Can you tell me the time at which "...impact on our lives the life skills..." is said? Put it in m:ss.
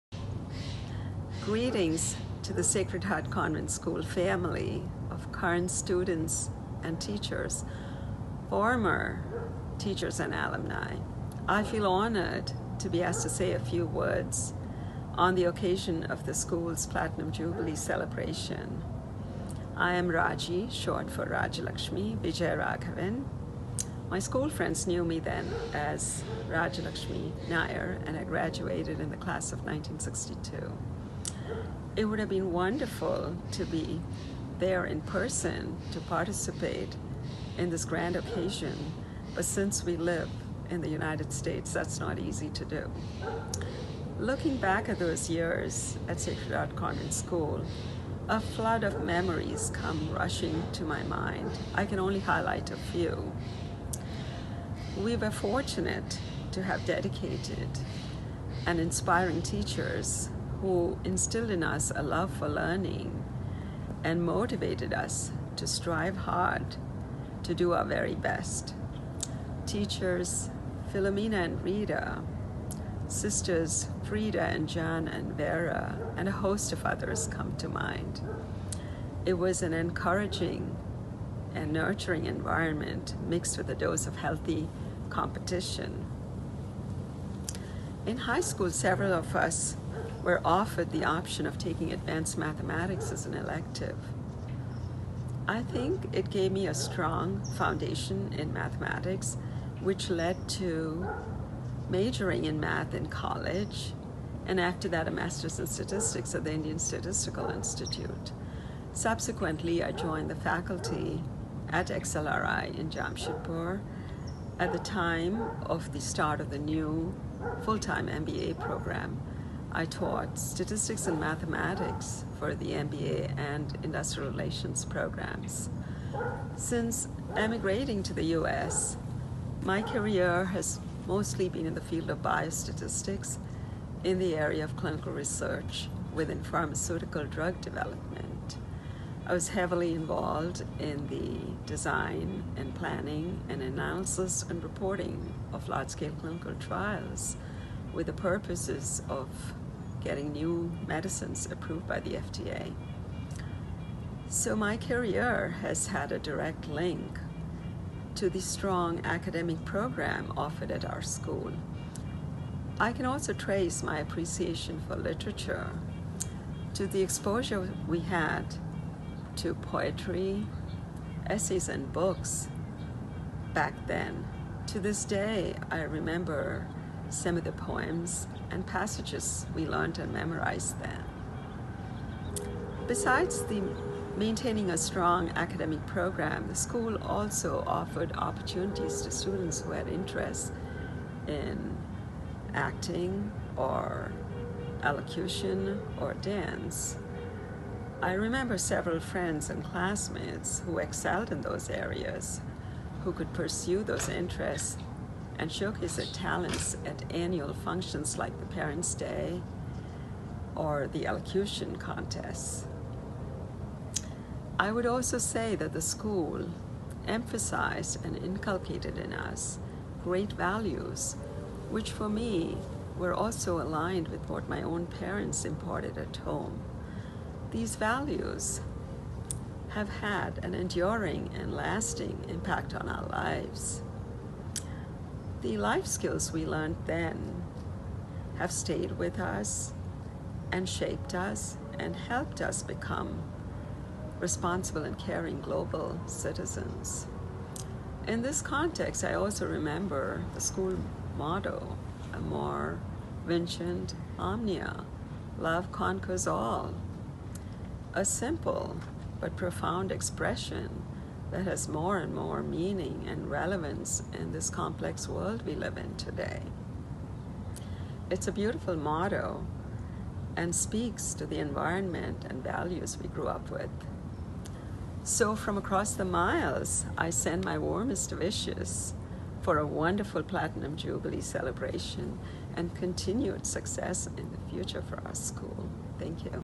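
3:52.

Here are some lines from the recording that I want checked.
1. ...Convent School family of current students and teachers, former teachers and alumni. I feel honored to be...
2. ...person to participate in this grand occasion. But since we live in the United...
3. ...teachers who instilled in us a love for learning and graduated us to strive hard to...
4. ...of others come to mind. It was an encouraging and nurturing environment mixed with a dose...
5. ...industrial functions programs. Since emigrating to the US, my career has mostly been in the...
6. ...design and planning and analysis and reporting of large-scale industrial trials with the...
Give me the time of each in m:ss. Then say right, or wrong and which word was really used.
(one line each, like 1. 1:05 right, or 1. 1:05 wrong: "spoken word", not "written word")
1. 0:03 right
2. 0:35 right
3. 0:59 wrong: "motivated", not "graduated"
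4. 1:16 right
5. 2:03 wrong: "relations", not "functions"
6. 2:21 wrong: "clinical", not "industrial".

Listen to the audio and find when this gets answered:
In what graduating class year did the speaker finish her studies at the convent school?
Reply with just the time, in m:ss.
0:29.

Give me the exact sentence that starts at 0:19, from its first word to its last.
I am Raji, short for Rajalakshmi Vijayaraghavan.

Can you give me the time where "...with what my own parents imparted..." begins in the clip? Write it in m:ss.
3:44.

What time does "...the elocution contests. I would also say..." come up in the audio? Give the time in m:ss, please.
3:30.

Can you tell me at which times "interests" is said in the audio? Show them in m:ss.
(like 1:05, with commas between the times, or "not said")
3:09, 3:24.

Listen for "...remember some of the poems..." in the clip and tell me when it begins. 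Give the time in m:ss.
2:55.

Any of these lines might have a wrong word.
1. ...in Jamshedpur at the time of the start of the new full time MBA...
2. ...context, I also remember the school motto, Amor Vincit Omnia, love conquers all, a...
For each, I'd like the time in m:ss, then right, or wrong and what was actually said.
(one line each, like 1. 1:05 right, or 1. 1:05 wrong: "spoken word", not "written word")
1. 1:52 right
2. 4:08 right.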